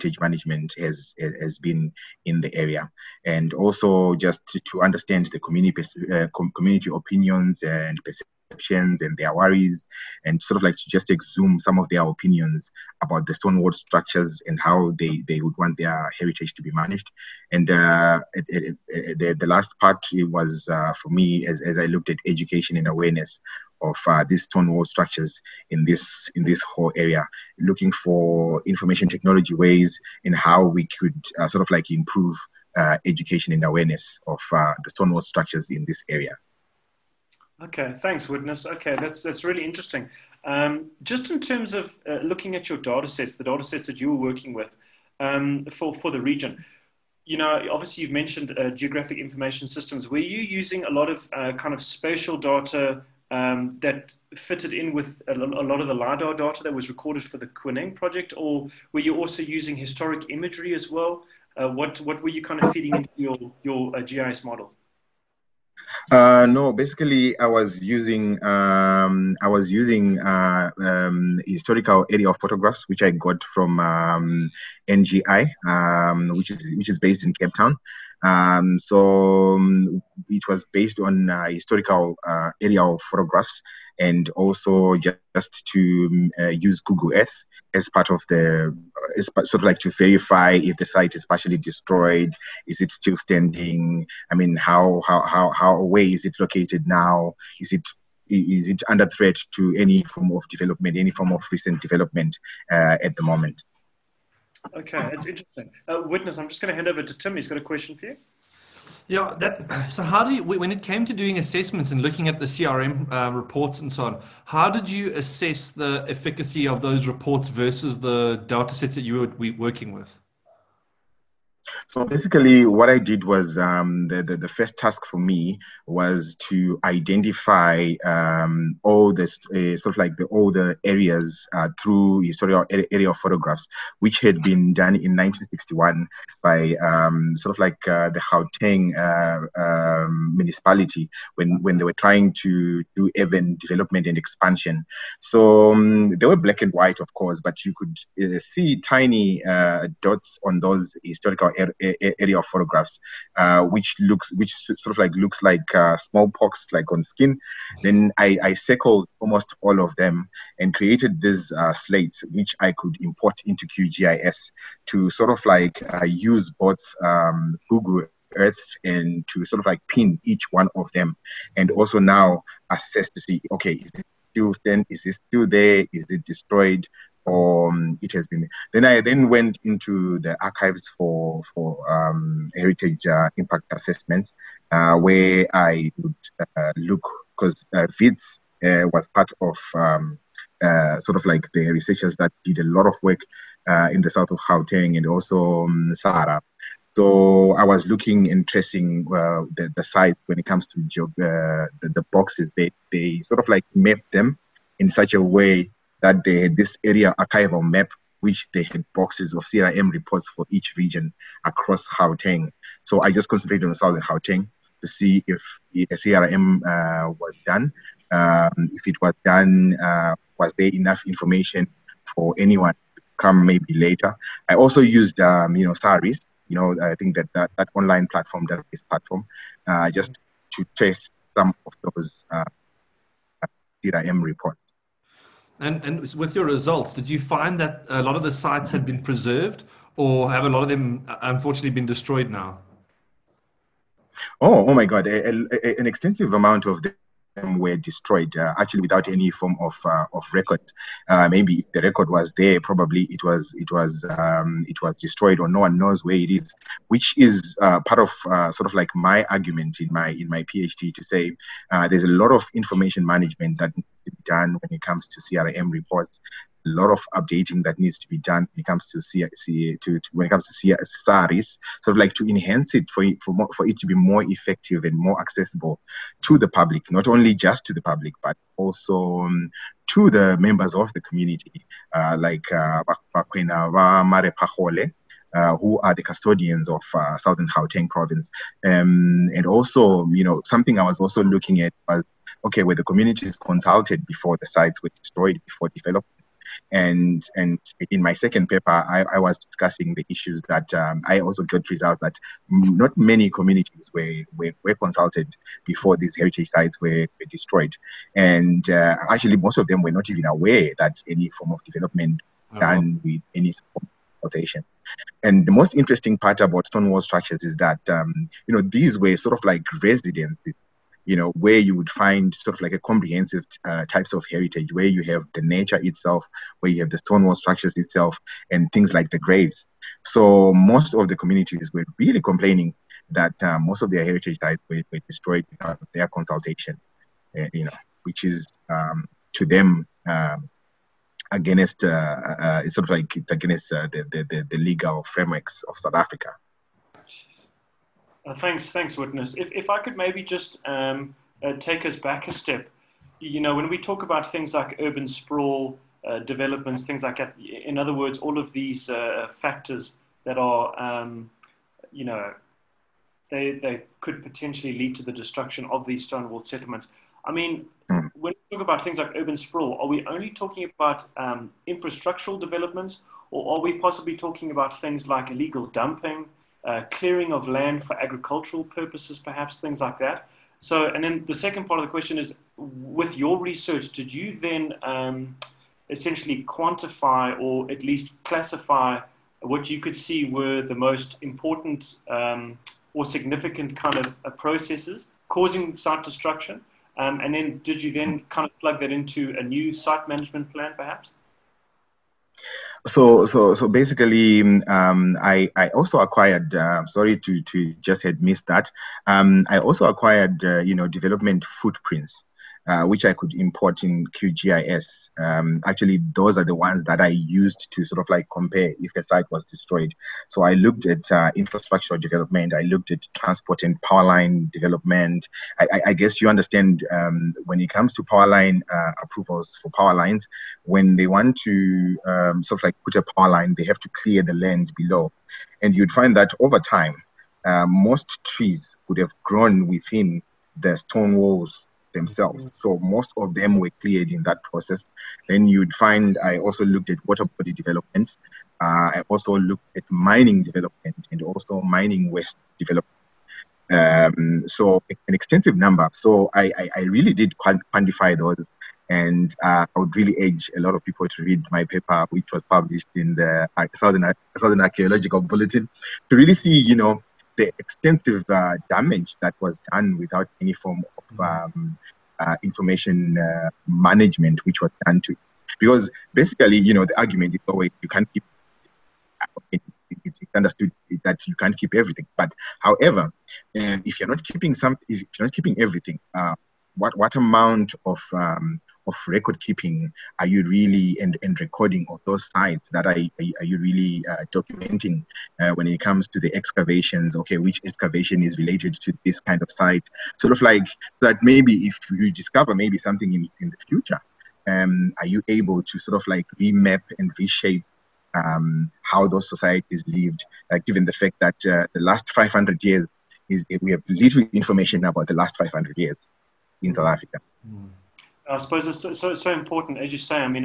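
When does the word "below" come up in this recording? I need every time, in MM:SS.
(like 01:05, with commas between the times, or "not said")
07:14.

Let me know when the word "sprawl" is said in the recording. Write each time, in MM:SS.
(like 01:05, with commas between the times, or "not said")
05:55, 06:09.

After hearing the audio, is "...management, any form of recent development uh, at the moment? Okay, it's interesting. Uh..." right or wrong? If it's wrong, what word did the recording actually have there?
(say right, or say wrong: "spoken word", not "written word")
wrong: "development", not "management".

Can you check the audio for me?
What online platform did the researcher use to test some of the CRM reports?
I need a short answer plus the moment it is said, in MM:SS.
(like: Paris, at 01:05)
SAHRIS, at 03:45.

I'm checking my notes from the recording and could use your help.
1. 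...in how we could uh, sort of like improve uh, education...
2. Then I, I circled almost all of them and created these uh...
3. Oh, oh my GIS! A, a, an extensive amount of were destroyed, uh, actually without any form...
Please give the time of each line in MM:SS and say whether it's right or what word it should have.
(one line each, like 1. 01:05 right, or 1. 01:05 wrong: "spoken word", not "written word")
1. 00:30 right
2. 02:37 right
3. 04:04 wrong: "God", not "GIS".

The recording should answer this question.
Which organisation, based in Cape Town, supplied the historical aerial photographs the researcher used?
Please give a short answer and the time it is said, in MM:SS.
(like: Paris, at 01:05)
NGI, at 01:14.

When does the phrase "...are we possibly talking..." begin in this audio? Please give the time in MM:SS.
06:13.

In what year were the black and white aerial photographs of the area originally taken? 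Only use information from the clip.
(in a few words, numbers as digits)
1961.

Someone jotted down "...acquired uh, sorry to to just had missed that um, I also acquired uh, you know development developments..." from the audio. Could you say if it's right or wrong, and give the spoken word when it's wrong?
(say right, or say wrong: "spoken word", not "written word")
wrong: "footprints", not "developments".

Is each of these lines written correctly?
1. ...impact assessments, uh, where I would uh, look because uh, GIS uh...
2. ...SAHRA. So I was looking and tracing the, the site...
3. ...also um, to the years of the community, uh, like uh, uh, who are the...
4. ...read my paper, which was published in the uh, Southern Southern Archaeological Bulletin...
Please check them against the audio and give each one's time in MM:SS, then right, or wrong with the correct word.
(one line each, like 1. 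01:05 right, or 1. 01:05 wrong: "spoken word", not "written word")
1. 03:03 wrong: "Wits", not "GIS"
2. 03:15 right
3. 04:38 wrong: "members", not "years"
4. 07:41 right.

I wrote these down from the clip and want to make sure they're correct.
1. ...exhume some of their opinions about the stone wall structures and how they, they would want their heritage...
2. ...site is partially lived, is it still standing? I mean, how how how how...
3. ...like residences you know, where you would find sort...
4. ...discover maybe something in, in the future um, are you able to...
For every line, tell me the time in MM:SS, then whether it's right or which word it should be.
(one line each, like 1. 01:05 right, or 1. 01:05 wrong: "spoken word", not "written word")
1. 00:11 right
2. 01:30 wrong: "destroyed", not "lived"
3. 05:19 right
4. 08:22 right.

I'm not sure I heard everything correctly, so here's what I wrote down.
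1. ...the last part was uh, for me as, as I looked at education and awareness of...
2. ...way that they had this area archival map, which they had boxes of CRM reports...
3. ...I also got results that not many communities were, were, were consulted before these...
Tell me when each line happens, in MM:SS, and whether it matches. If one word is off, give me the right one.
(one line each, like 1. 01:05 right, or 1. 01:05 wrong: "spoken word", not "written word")
1. 00:19 right
2. 03:25 right
3. 05:01 right.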